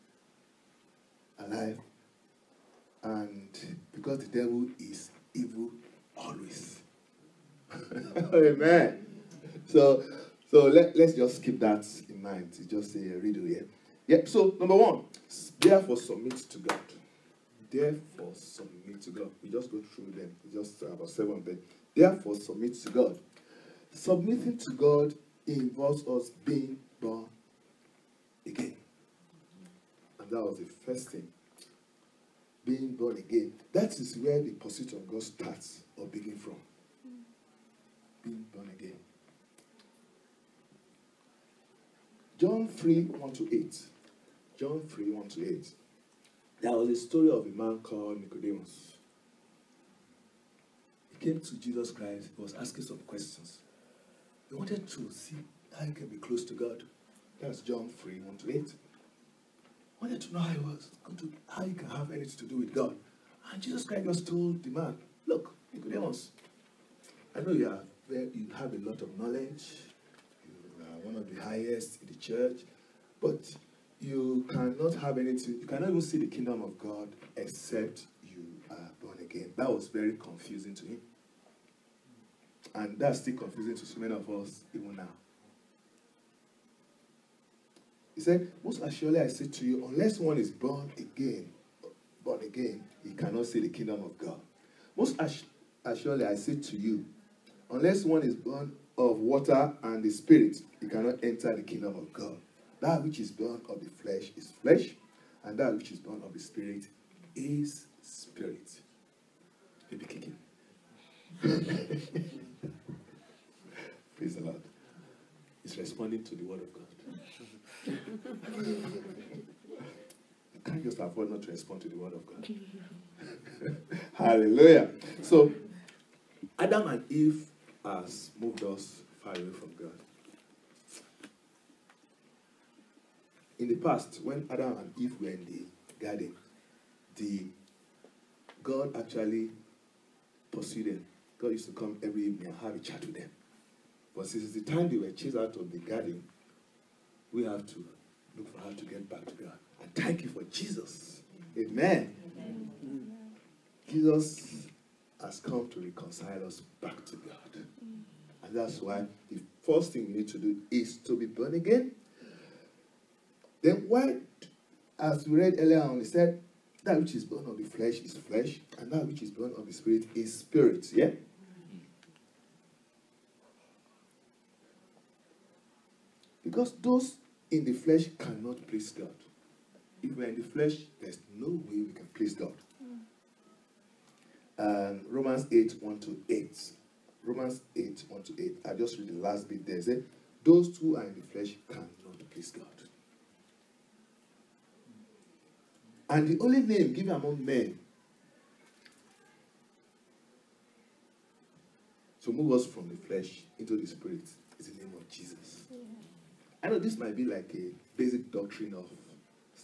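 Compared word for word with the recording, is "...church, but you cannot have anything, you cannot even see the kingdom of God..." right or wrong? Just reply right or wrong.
right.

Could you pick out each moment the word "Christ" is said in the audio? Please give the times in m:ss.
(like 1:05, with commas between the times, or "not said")
0:51, 1:03.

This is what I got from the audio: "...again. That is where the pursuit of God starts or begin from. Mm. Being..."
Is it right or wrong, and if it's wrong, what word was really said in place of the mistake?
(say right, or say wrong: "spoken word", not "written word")
right.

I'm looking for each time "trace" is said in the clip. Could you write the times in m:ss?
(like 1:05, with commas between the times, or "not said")
not said.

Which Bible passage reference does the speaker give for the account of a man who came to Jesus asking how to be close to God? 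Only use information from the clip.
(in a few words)
John 3:1-8.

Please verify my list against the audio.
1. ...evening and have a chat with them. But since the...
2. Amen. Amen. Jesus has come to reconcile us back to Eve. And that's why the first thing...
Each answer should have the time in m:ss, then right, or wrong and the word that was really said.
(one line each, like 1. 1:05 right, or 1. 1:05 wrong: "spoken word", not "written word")
1. 2:22 right
2. 2:31 wrong: "God", not "Eve".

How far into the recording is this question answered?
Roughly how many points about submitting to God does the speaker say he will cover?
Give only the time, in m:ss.
0:21.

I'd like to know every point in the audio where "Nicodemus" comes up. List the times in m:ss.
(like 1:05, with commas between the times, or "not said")
0:48, 1:05.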